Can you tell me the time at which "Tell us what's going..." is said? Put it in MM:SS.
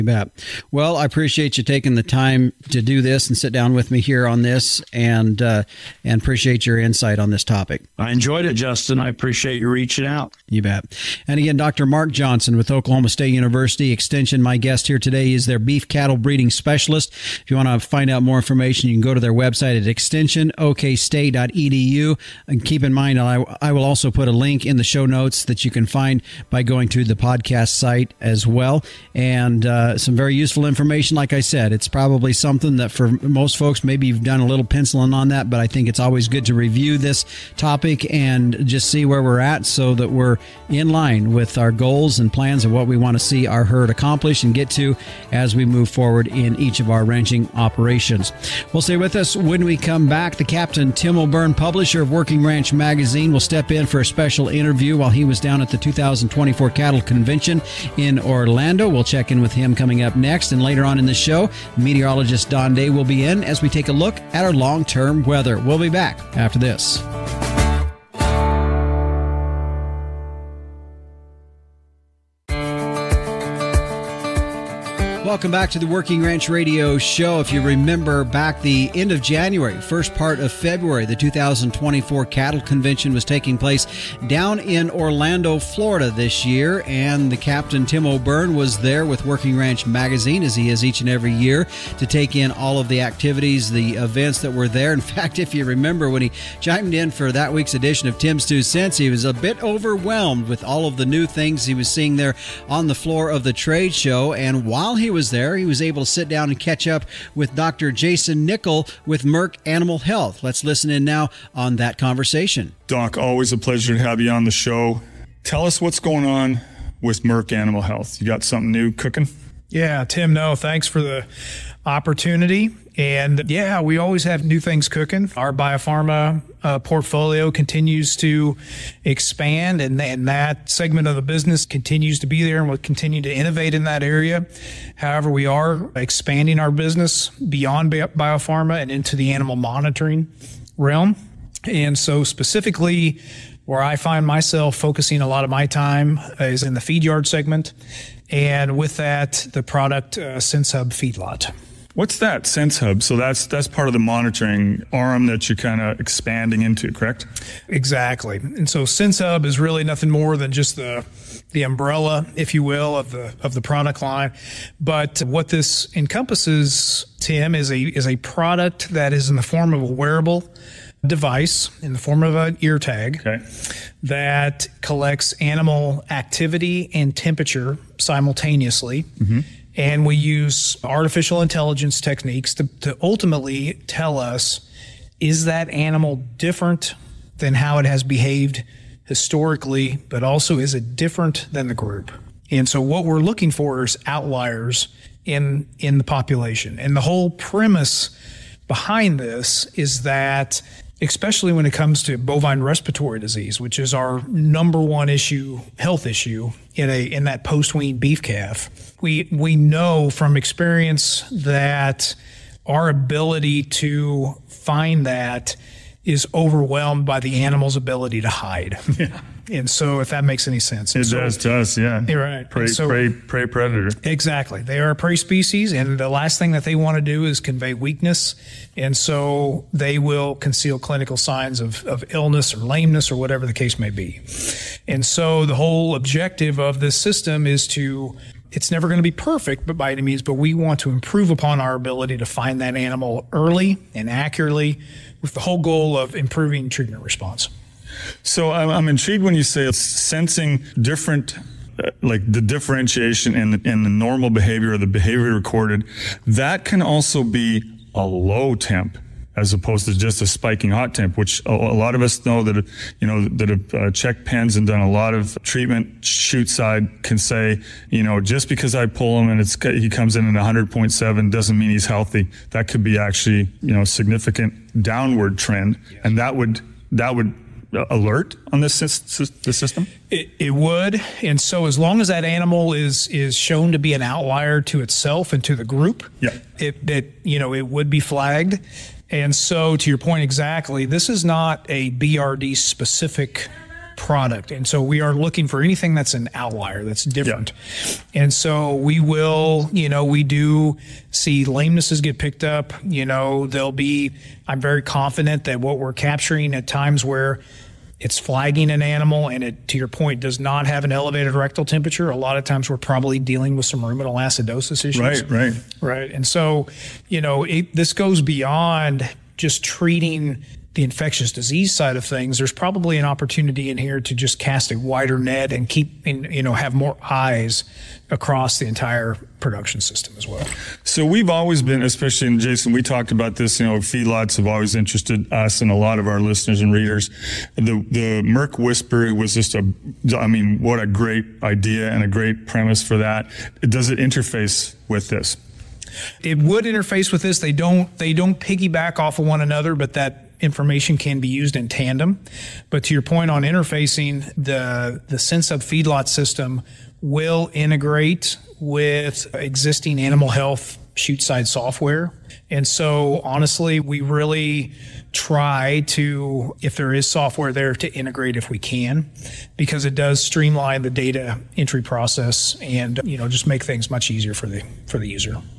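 01:55.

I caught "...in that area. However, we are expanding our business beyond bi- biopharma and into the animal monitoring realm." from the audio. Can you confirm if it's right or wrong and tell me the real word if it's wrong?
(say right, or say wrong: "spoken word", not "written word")
right.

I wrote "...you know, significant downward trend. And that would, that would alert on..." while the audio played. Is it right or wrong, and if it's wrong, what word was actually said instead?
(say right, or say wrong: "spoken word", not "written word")
right.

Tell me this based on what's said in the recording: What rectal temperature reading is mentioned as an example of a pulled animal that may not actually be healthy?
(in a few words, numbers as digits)
100.7.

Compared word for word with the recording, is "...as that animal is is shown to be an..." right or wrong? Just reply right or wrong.
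right.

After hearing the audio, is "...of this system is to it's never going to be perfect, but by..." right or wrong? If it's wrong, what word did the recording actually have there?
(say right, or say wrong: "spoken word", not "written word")
right.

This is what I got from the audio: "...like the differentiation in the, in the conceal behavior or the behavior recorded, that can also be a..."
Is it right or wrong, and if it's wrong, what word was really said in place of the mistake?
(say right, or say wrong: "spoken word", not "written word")
wrong: "normal", not "conceal".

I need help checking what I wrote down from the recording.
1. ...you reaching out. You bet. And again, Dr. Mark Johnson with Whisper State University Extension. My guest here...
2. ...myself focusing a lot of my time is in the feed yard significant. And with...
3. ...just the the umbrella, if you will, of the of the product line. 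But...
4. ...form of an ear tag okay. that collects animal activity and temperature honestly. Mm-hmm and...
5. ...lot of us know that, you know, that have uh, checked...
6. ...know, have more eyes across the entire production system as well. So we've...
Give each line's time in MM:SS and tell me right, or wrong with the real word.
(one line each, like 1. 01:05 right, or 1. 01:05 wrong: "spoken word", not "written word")
1. 00:09 wrong: "Oklahoma", not "Whisper"
2. 02:24 wrong: "segment", not "significant"
3. 02:40 right
4. 02:51 wrong: "simultaneously", not "honestly"
5. 04:21 right
6. 05:26 right.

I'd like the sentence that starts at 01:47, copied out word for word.
Jason Nickell with Merck Animal Health.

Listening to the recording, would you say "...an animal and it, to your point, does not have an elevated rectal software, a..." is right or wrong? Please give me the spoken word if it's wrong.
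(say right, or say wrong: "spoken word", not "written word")
wrong: "temperature", not "software".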